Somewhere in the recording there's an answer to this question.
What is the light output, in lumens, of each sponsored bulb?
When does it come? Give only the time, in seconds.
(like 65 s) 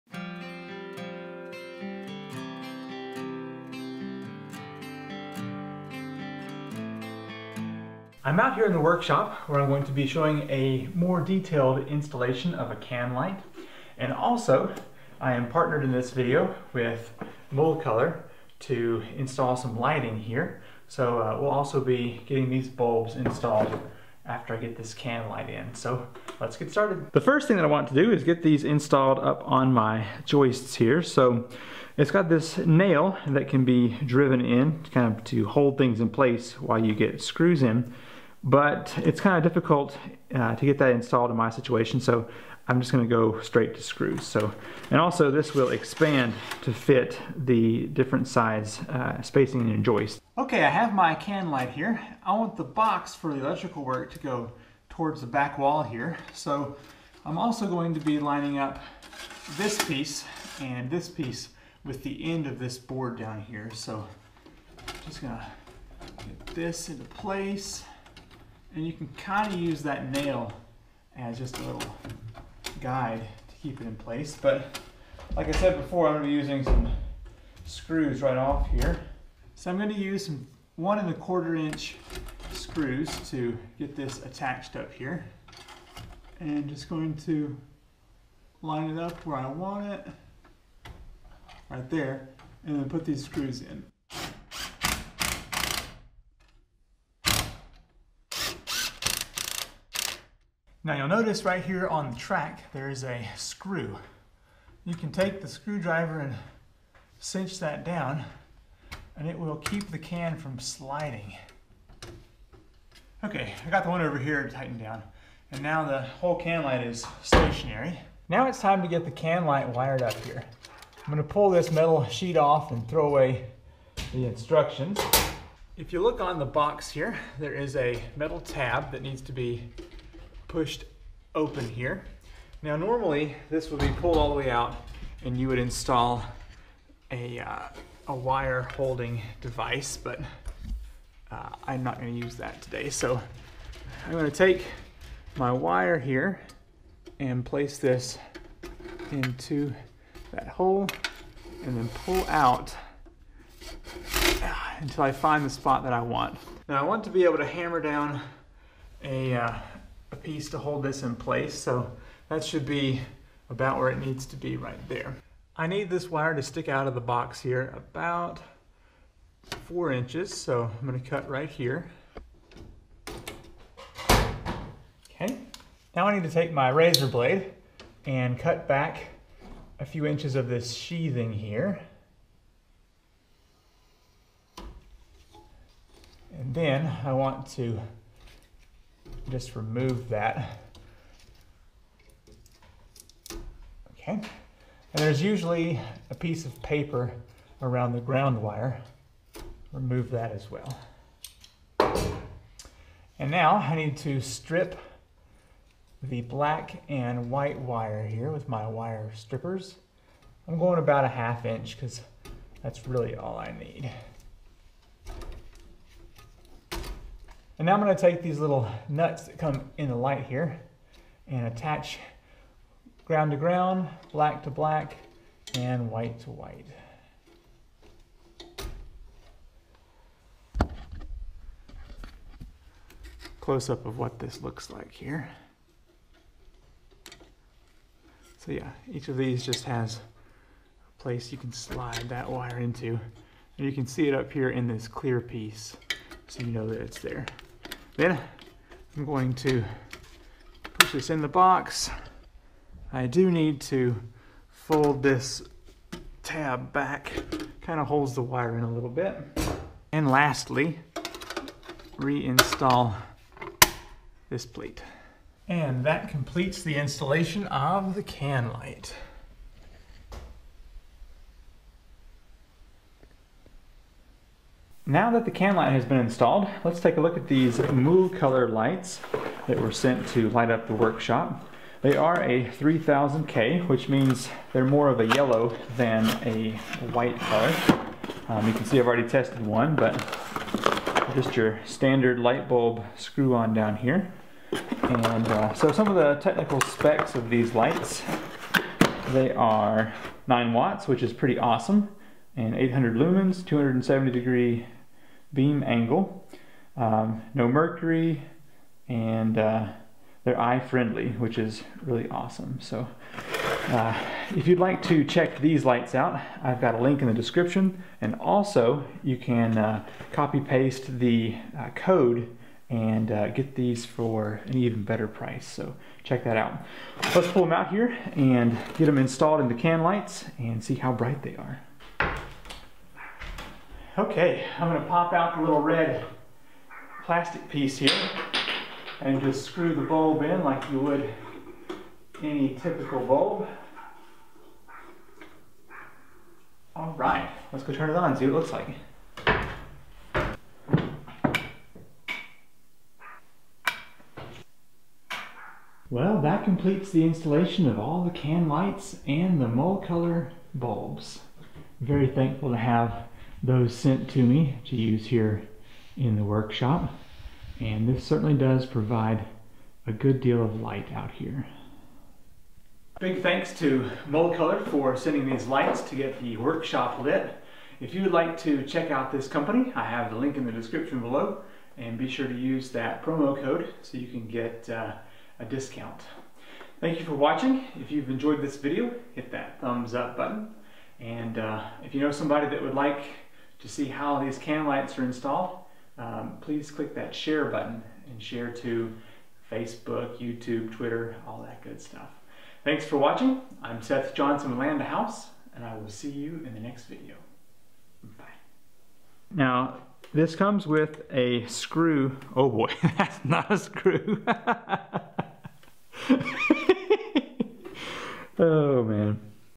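302 s.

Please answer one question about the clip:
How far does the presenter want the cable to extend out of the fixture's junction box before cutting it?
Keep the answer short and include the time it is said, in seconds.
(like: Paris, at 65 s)
4 inches, at 169 s.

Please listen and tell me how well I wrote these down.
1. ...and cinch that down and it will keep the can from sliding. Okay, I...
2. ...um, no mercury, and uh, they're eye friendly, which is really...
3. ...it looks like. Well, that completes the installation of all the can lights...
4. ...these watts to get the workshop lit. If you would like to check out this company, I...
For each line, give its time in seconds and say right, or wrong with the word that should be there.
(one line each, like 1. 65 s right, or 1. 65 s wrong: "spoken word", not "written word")
1. 106 s right
2. 306 s right
3. 348 s right
4. 375 s wrong: "lights", not "watts".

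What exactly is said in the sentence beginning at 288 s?
Um, you can see I've already tested one, but just your standard light bulb screw on down here.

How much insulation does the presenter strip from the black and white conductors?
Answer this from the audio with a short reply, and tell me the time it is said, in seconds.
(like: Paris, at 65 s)
half inch, at 211 s.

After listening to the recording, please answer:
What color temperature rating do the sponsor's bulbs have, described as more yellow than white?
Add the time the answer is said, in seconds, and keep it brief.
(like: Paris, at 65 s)
3000K, at 282 s.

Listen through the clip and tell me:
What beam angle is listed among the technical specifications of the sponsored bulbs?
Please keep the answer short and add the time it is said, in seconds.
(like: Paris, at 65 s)
270 degrees, at 303 s.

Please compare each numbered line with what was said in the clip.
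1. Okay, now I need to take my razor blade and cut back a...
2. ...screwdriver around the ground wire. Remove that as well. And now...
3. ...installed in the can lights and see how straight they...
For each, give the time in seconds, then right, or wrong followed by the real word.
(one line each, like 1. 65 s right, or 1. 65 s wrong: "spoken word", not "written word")
1. 175 s right
2. 196 s wrong: "paper", not "screwdriver"
3. 328 s wrong: "bright", not "straight".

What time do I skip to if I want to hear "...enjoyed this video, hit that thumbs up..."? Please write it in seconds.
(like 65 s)
388 s.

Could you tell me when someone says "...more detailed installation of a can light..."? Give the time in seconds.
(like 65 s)
10 s.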